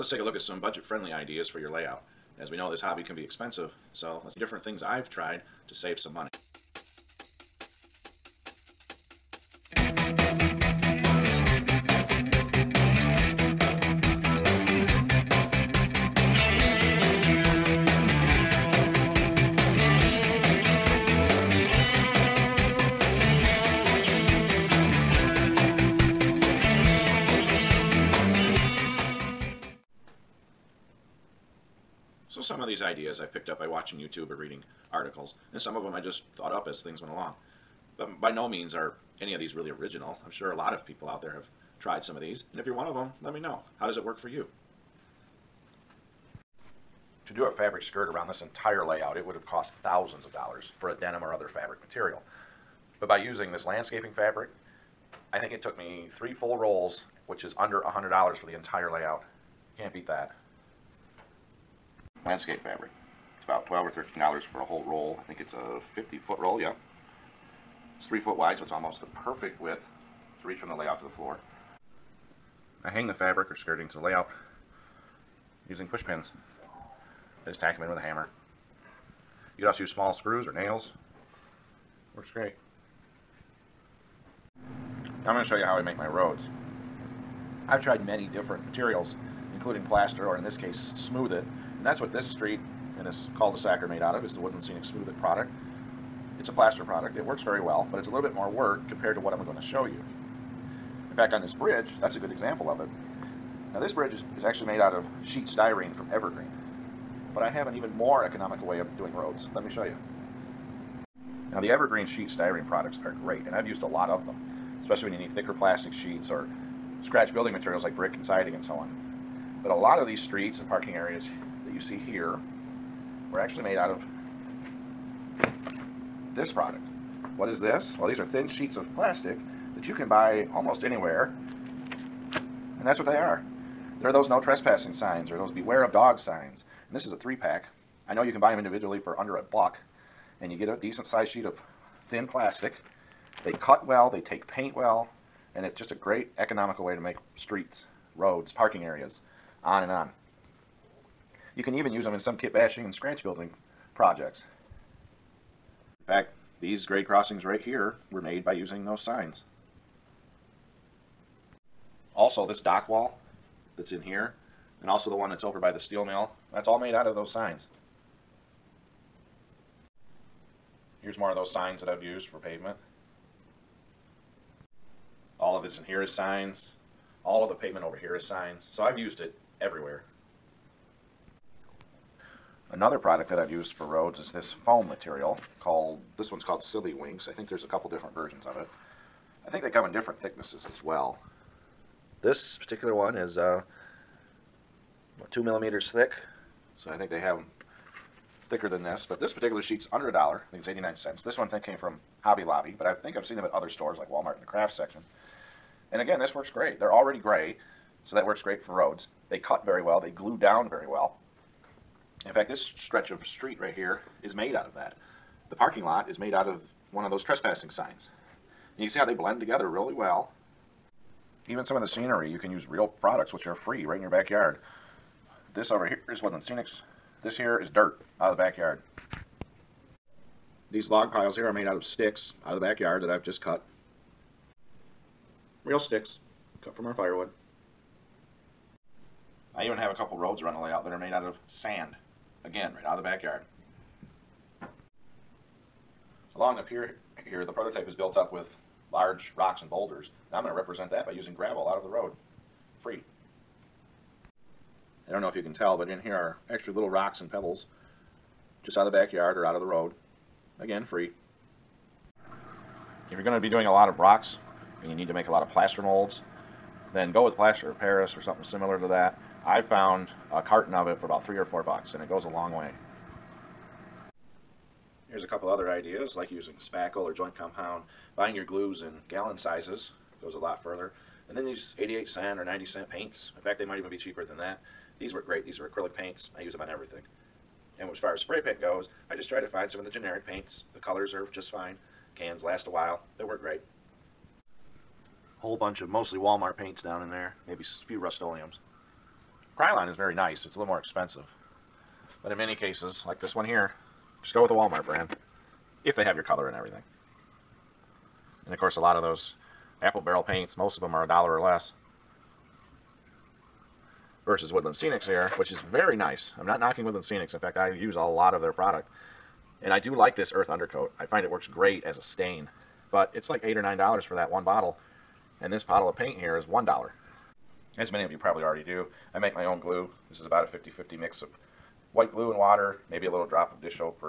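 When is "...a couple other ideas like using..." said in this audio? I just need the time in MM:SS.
04:35.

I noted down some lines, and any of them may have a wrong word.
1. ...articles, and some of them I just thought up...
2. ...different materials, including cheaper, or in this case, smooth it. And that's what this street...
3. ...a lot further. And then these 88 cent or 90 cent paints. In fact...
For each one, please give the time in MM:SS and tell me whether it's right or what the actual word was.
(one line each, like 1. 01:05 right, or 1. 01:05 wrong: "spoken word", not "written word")
1. 00:34 right
2. 01:28 wrong: "plaster", not "cheaper"
3. 04:40 right.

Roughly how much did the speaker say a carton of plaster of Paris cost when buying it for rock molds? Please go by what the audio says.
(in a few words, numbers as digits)
3 or 4 dollars.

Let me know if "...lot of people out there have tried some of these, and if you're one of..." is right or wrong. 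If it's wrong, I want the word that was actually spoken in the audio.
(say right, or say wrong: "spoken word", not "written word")
right.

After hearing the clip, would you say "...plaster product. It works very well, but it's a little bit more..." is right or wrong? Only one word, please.
right.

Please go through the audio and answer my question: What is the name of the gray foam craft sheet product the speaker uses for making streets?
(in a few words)
Silly Winks.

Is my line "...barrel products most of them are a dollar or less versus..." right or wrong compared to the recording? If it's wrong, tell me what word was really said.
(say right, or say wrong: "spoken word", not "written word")
wrong: "paints", not "products".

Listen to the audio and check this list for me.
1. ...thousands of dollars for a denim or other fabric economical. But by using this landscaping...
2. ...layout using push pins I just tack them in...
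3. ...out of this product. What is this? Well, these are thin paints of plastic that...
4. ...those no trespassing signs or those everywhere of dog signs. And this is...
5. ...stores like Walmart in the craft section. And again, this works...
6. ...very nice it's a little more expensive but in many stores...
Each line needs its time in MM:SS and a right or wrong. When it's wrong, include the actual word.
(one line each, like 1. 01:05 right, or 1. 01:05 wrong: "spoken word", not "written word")
1. 00:49 wrong: "material", not "economical"
2. 01:13 right
3. 02:03 wrong: "sheets", not "paints"
4. 02:14 wrong: "beware", not "everywhere"
5. 03:23 right
6. 04:59 wrong: "cases", not "stores".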